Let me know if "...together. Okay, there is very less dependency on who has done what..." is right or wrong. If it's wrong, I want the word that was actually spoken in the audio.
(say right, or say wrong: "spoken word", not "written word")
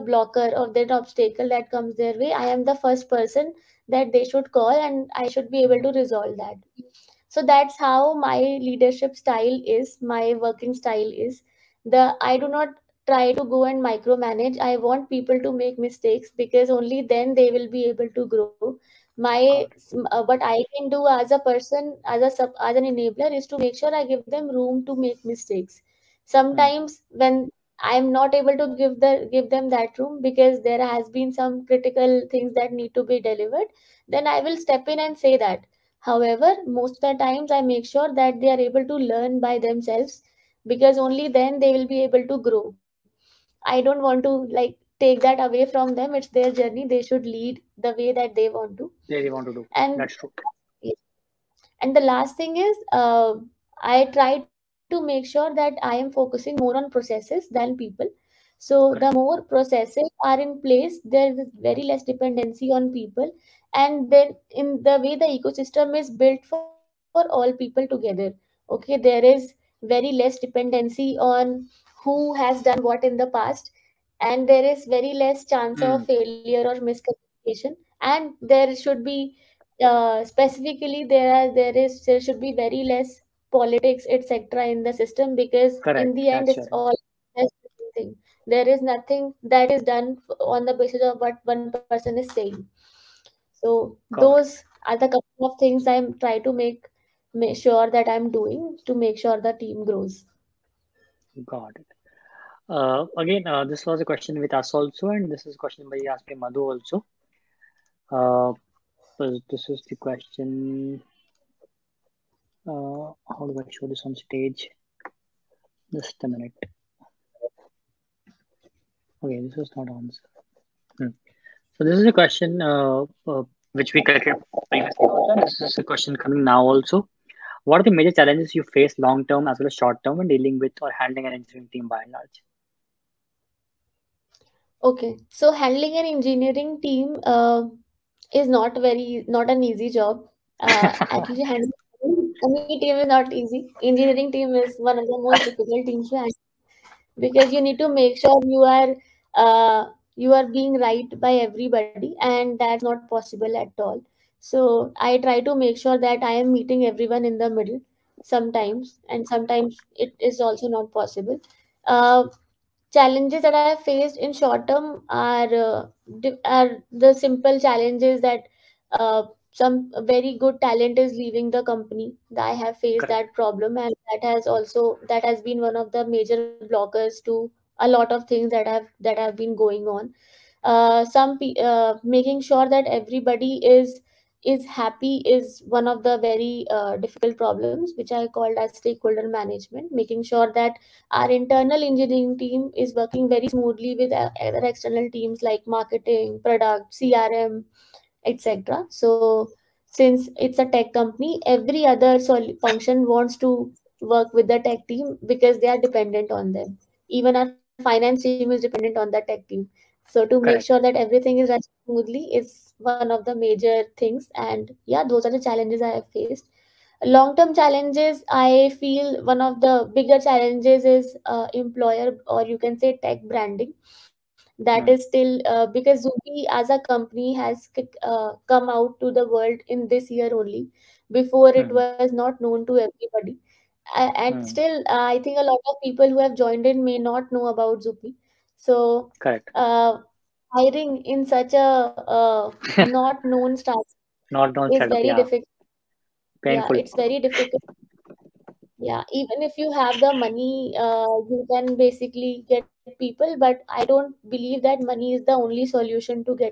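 right.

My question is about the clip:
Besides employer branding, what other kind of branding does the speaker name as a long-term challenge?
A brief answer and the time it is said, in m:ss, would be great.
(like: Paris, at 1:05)
Tech branding, at 3:43.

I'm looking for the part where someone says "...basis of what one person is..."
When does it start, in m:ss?
1:30.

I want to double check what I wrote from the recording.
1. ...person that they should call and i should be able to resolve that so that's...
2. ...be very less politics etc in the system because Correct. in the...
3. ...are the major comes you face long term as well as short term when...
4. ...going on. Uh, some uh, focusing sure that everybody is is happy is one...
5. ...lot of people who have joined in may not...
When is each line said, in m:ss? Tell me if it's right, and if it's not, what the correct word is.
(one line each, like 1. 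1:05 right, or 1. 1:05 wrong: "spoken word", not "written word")
1. 0:03 right
2. 1:22 right
3. 2:07 wrong: "challenges", not "comes"
4. 2:59 wrong: "making", not "focusing"
5. 3:55 right.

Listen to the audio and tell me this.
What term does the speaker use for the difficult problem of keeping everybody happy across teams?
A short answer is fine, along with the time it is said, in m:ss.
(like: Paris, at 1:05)
Stakeholder management, at 3:08.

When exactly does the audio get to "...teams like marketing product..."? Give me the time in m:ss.
3:15.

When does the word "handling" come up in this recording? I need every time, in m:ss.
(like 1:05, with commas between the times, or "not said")
2:10, 2:15, 2:21.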